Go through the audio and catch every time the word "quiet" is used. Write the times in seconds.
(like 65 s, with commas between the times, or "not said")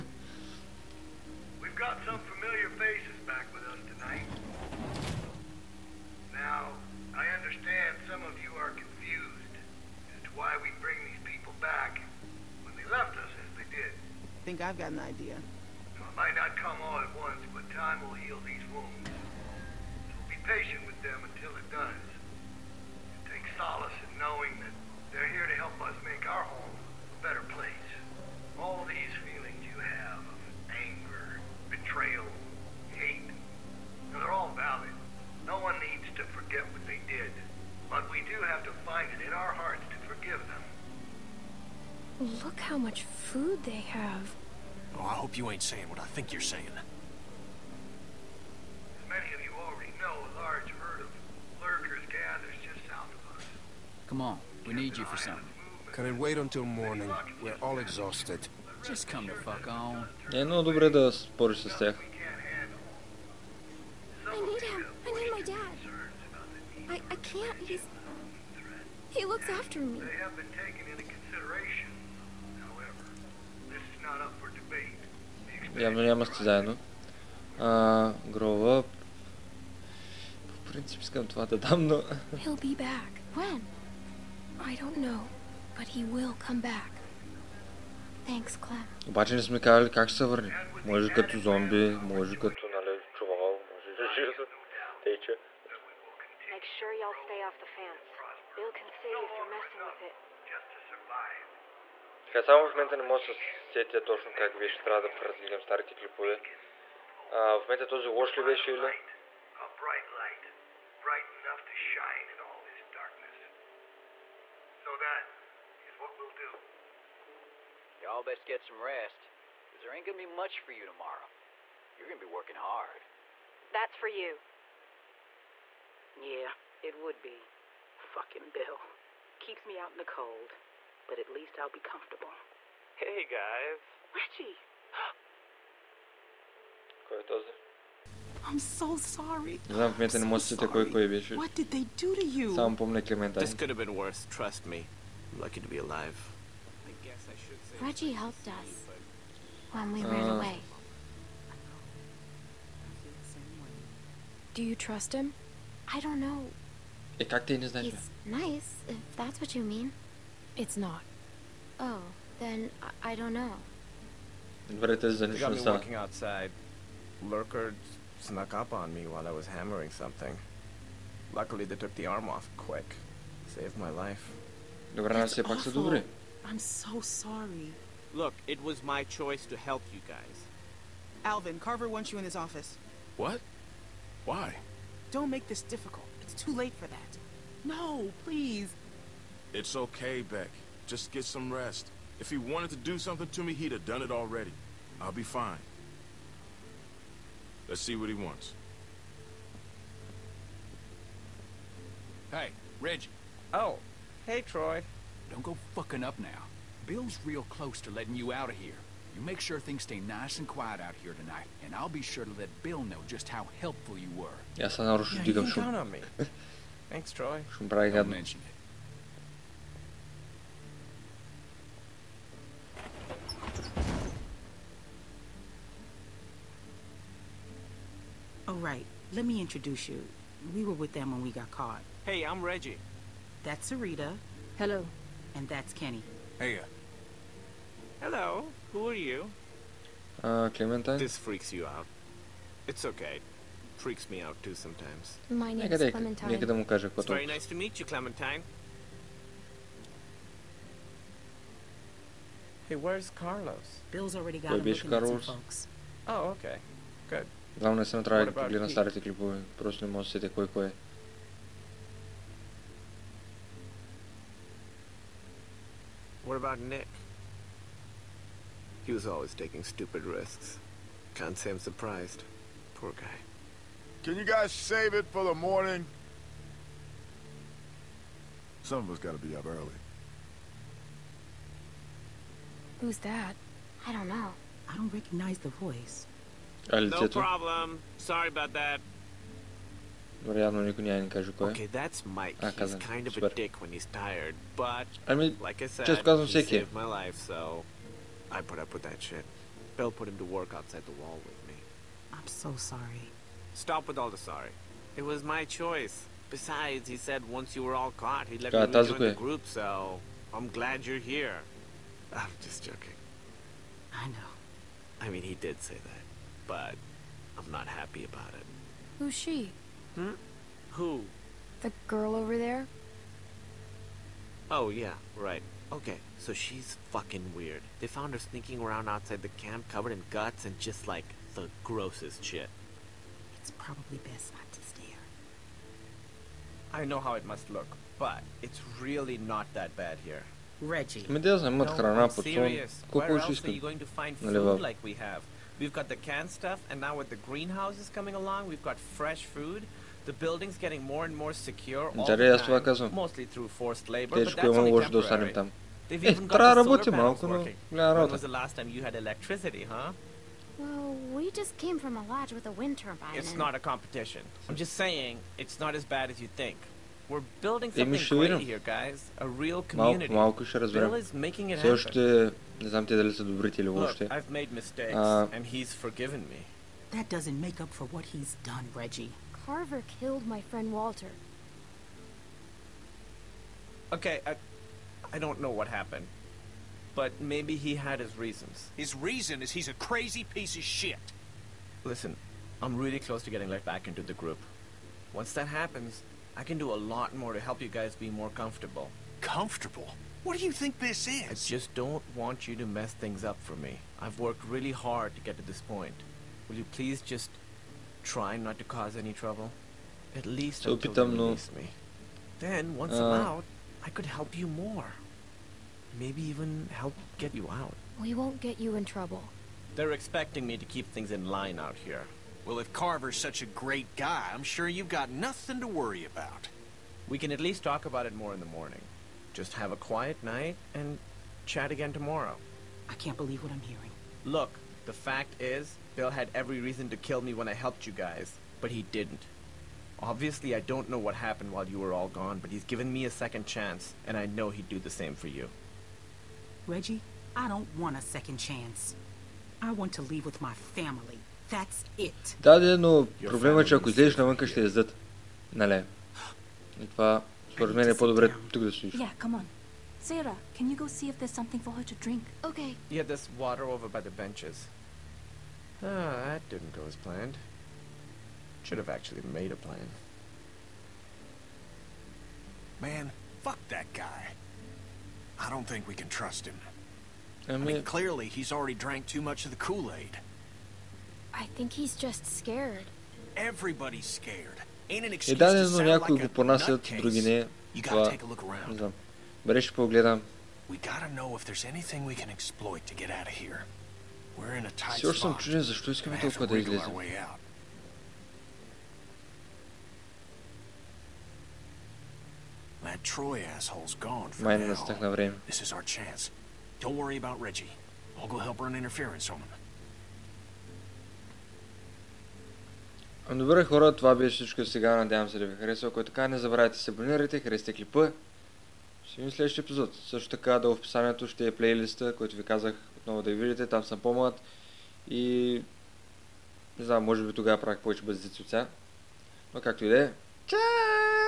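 210 s, 429 s.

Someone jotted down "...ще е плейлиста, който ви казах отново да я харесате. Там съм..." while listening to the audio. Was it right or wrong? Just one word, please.
wrong.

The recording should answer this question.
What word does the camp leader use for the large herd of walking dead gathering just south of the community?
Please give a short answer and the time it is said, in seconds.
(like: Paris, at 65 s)
lurkers, at 51 s.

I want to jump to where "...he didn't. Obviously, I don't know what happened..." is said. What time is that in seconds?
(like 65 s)
438 s.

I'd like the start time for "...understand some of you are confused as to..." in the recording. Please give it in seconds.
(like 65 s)
7 s.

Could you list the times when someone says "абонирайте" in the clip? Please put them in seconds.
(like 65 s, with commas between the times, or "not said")
516 s.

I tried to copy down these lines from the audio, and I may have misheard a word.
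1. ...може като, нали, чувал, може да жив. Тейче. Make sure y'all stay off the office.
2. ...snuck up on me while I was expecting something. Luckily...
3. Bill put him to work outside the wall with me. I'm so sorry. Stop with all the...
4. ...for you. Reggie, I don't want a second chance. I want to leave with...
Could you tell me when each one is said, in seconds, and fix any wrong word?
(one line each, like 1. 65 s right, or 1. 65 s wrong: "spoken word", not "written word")
1. 92 s wrong: "fence", not "office"
2. 168 s wrong: "hammering", not "expecting"
3. 299 s right
4. 445 s right.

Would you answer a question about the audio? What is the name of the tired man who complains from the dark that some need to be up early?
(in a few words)
Mike.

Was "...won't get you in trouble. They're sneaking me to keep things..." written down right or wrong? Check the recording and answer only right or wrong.
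wrong.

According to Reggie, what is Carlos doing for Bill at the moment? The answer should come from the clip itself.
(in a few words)
looking at some folks.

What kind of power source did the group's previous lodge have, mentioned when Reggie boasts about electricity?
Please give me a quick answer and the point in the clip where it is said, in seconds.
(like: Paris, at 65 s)
a wind turbine, at 362 s.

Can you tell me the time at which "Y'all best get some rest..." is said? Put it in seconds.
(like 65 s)
118 s.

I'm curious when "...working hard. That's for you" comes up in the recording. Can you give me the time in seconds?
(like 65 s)
122 s.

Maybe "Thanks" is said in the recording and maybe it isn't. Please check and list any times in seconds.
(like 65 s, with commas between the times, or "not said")
88 s, 216 s.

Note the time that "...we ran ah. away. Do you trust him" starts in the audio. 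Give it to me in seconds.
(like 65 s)
149 s.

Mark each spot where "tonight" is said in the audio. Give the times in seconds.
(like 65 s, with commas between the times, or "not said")
3 s, 211 s.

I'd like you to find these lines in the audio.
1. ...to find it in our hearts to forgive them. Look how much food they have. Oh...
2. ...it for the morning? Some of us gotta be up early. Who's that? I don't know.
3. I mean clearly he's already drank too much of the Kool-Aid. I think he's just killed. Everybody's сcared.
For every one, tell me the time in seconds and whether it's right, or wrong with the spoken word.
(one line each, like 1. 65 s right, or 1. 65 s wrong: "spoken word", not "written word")
1. 38 s right
2. 275 s right
3. 477 s wrong: "scared", not "killed".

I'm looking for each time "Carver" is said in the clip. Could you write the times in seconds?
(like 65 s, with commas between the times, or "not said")
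181 s, 379 s, 422 s.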